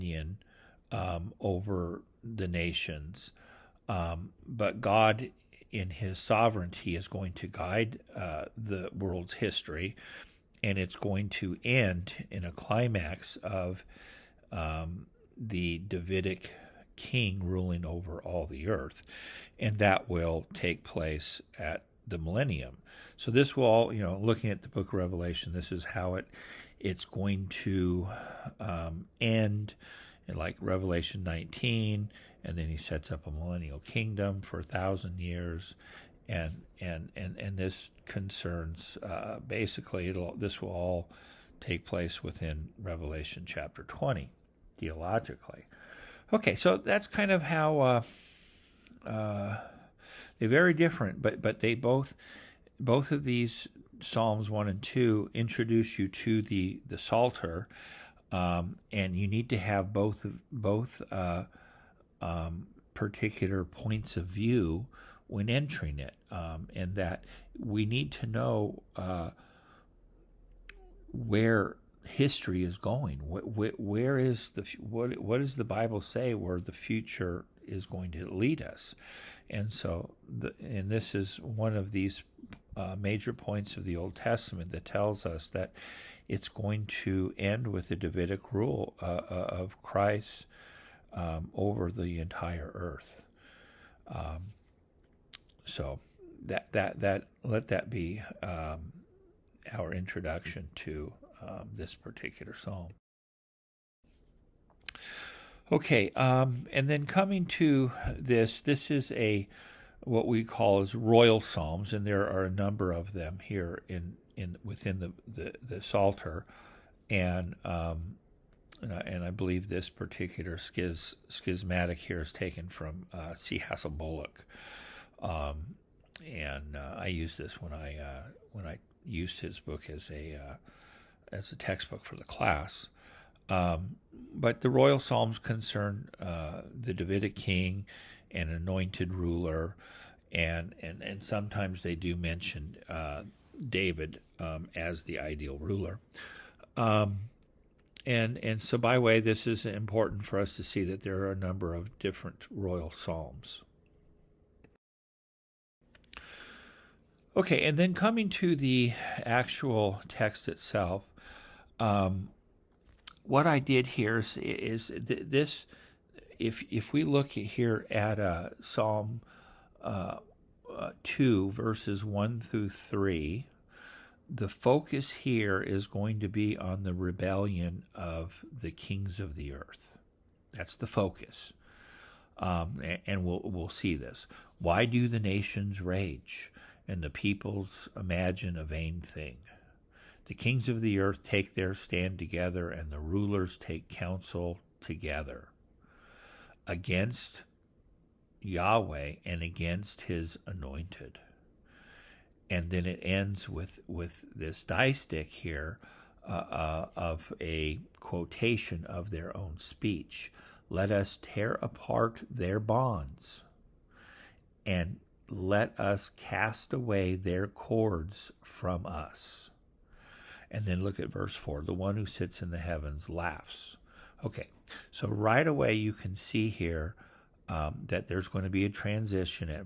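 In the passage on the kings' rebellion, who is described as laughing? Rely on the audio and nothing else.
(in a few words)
The one who sits in the heavens.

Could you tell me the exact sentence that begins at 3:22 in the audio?
And then it ends with, with this stick here uh, uh, of a quotation of their own speech.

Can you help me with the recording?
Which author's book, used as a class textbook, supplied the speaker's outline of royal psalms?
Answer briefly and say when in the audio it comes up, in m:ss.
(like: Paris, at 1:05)
C. Hassell Bullock, at 2:03.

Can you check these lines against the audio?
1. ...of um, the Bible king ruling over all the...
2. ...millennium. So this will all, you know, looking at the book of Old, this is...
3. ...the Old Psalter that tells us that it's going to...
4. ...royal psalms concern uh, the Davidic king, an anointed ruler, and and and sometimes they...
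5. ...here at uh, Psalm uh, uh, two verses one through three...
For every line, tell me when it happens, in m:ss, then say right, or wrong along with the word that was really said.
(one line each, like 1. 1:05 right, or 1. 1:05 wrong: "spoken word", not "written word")
1. 0:13 wrong: "Davidic", not "Bible"
2. 0:22 wrong: "Revelation", not "Old"
3. 1:23 wrong: "Testament", not "Psalter"
4. 2:14 right
5. 2:47 right.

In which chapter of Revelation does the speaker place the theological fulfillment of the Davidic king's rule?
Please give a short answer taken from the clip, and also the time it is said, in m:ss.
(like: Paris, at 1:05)
Revelation chapter 20, at 0:42.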